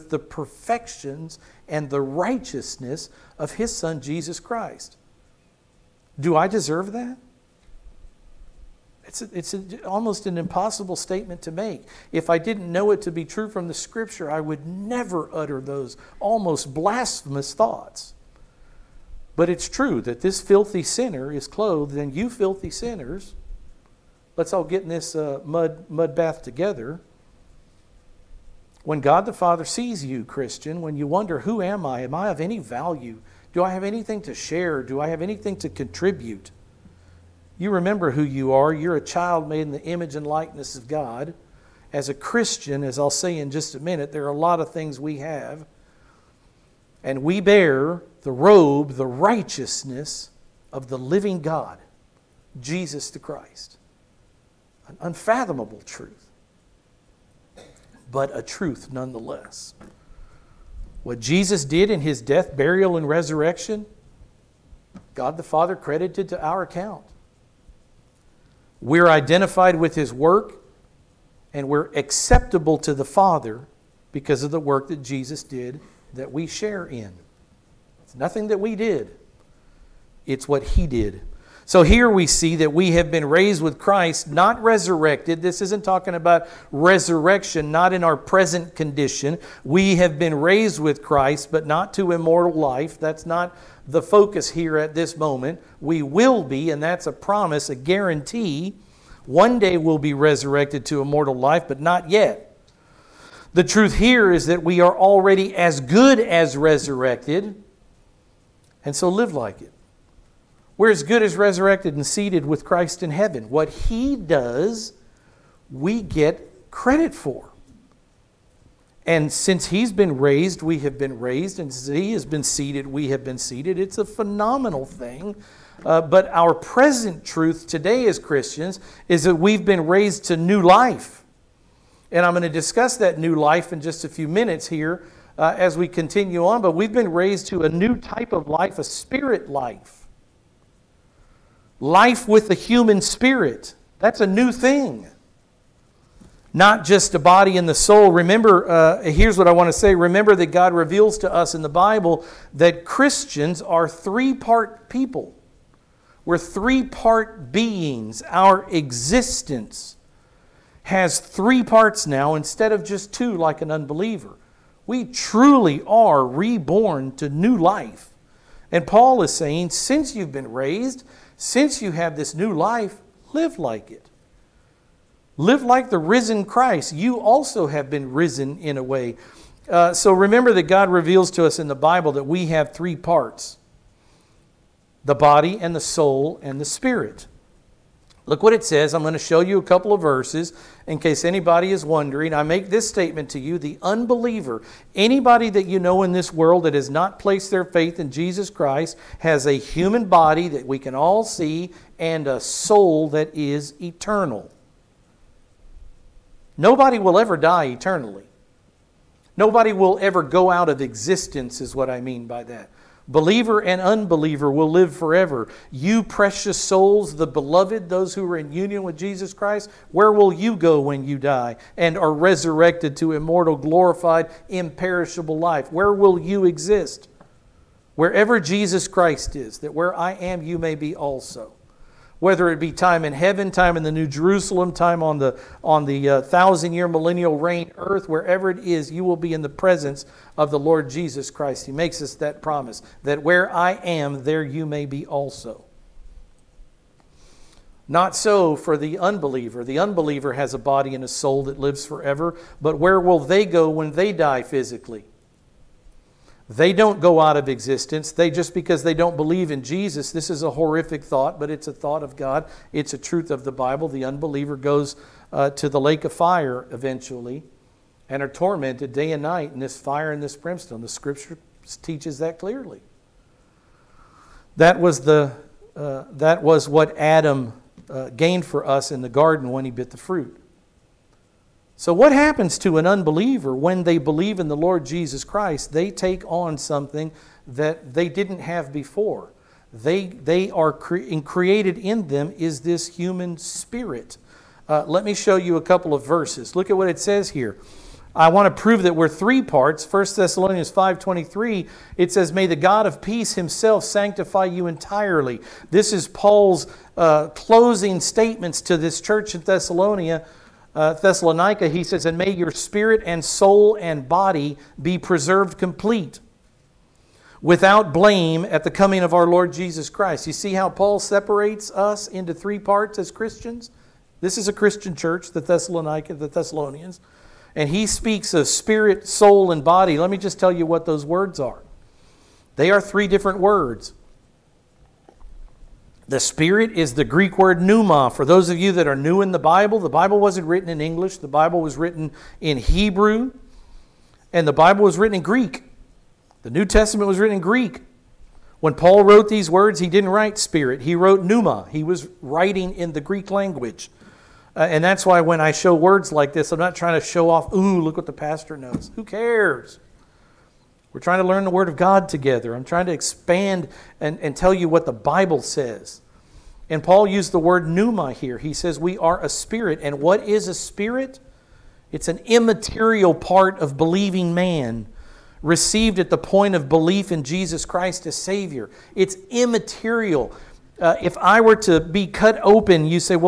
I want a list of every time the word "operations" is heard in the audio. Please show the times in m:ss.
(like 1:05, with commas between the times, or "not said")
not said.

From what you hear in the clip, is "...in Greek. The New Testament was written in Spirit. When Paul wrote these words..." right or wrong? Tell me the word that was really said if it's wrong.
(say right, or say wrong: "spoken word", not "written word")
wrong: "Greek", not "Spirit".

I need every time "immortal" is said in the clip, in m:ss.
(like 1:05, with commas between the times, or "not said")
1:32, 1:41, 3:43.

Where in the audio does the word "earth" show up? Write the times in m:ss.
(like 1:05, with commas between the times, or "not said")
3:57.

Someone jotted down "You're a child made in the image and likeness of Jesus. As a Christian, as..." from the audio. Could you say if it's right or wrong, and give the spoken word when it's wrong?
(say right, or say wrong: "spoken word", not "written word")
wrong: "God", not "Jesus".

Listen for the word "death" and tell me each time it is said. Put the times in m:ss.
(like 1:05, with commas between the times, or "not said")
1:02.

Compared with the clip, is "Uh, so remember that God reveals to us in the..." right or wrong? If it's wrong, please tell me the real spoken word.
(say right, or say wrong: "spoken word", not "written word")
right.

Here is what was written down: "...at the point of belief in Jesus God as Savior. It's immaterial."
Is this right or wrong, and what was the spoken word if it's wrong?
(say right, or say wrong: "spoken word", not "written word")
wrong: "Christ", not "God".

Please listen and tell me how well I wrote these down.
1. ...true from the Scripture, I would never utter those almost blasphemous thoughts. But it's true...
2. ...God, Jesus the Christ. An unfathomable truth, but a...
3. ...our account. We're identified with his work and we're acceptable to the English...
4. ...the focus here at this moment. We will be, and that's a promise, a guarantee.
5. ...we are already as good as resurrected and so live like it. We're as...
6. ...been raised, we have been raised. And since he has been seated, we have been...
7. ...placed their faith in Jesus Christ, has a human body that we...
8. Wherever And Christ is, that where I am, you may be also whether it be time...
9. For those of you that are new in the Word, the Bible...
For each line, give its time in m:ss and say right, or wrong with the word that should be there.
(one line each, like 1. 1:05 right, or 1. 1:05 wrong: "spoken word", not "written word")
1. 0:13 right
2. 0:51 right
3. 1:06 wrong: "Father", not "English"
4. 1:33 right
5. 1:44 right
6. 1:59 right
7. 3:17 right
8. 3:47 wrong: "Jesus", not "And"
9. 5:38 wrong: "Bible", not "Word".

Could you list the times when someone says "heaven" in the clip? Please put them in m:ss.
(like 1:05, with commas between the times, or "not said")
1:53, 3:53.